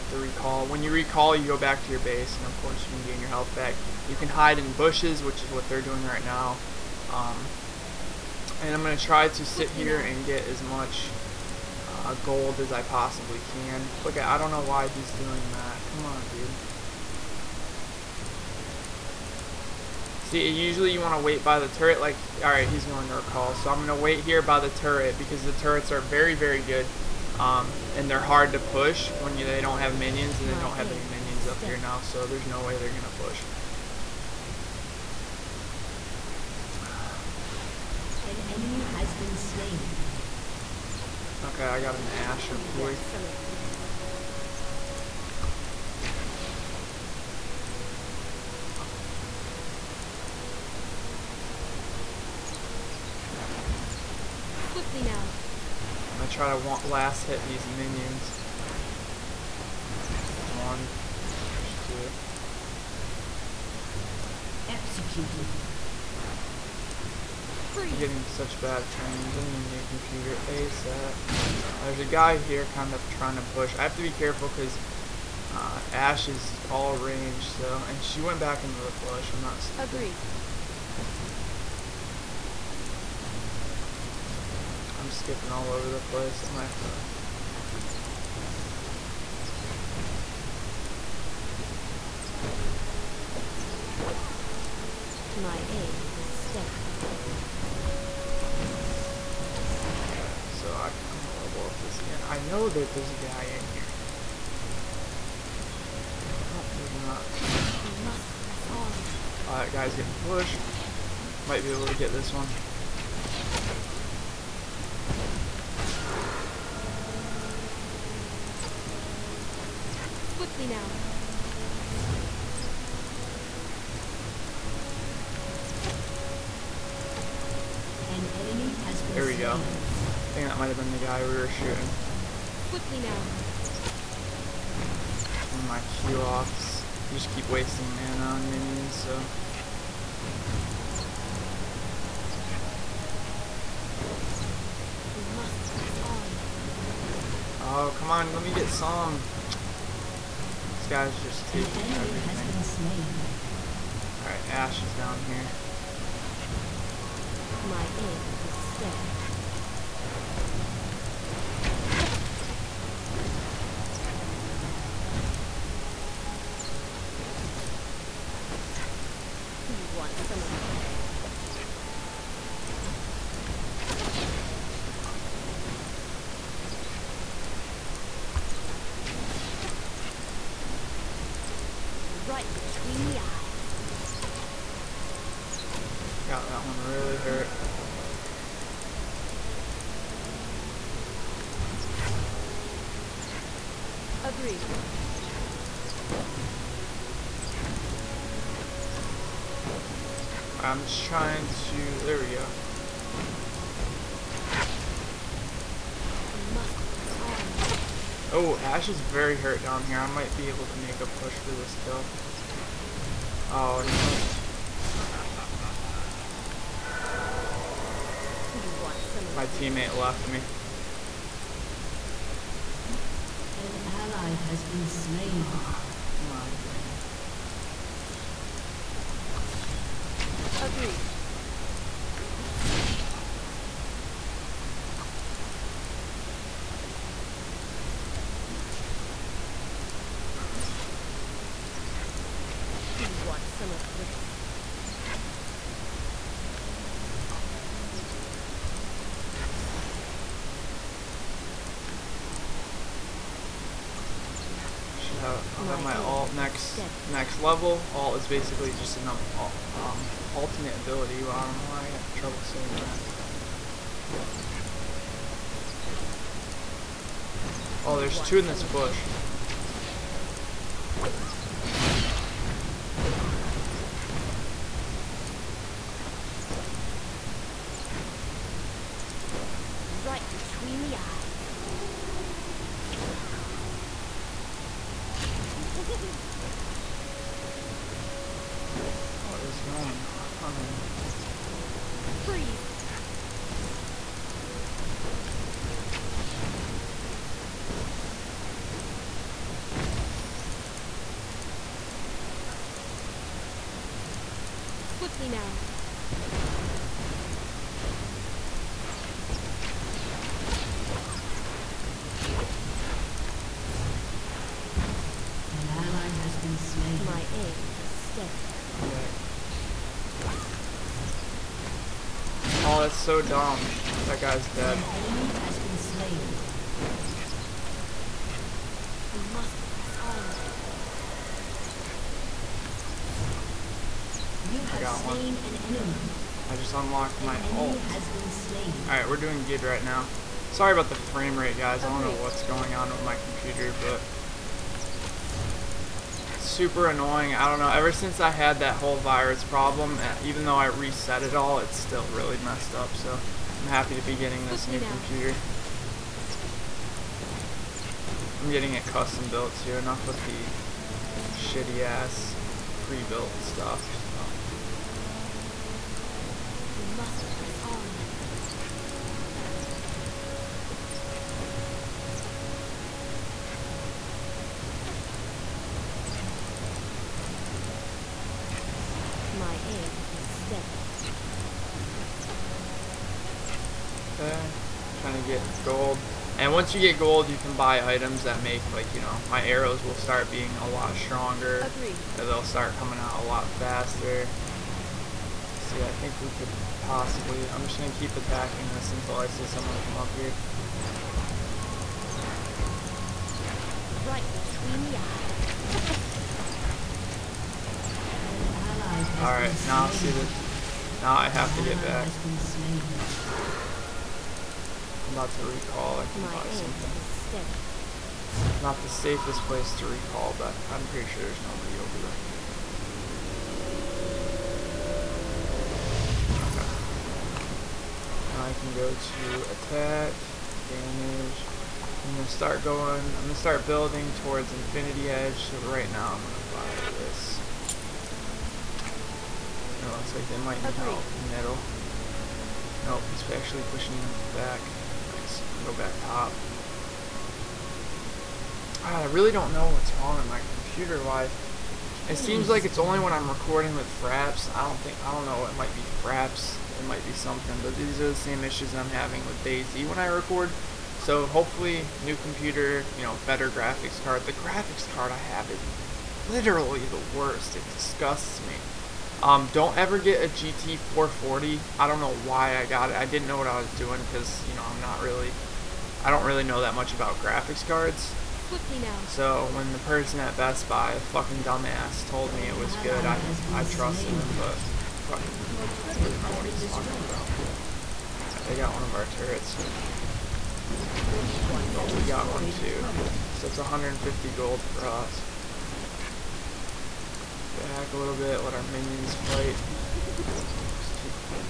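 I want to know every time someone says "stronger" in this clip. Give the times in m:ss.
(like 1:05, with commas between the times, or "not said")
6:30.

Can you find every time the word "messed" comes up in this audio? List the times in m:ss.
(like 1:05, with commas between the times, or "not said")
5:52.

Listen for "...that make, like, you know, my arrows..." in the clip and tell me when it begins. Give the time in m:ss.
6:28.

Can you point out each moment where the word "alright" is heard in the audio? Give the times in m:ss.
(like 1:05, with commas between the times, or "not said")
0:22, 2:34, 5:18, 5:38, 6:49.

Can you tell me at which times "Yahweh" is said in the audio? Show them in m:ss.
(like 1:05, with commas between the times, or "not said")
not said.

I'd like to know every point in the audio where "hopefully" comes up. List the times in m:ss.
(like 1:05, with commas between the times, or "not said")
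7:41.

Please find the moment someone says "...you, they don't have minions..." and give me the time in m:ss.
0:29.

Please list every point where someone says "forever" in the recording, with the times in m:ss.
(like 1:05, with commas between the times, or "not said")
not said.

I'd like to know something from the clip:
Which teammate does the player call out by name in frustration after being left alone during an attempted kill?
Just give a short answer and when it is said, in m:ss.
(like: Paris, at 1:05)
Garen, at 3:46.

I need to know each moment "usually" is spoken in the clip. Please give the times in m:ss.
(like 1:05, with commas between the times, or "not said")
0:20.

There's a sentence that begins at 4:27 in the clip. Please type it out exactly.
Oh, there's two in this bush.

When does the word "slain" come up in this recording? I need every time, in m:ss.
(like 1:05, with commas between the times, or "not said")
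0:39, 3:44, 5:16.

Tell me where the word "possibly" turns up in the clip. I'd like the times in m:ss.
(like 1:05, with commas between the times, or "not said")
0:12, 6:36.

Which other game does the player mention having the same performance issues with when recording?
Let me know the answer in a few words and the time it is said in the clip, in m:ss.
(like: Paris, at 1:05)
DayZ, at 7:39.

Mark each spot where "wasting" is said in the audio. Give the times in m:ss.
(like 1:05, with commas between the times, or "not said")
2:17.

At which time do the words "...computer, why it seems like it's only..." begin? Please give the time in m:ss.
7:30.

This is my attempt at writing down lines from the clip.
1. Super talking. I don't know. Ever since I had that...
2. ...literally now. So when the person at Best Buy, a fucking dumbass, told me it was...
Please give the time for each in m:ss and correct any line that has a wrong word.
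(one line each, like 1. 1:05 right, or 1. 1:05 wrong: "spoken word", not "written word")
1. 5:46 wrong: "annoying", not "talking"
2. 7:58 wrong: "swiftly", not "literally".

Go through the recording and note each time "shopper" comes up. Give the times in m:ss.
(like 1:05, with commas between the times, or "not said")
not said.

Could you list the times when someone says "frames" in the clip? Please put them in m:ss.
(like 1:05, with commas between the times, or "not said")
1:08, 5:40.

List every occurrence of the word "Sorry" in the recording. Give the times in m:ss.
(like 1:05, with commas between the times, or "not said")
5:40.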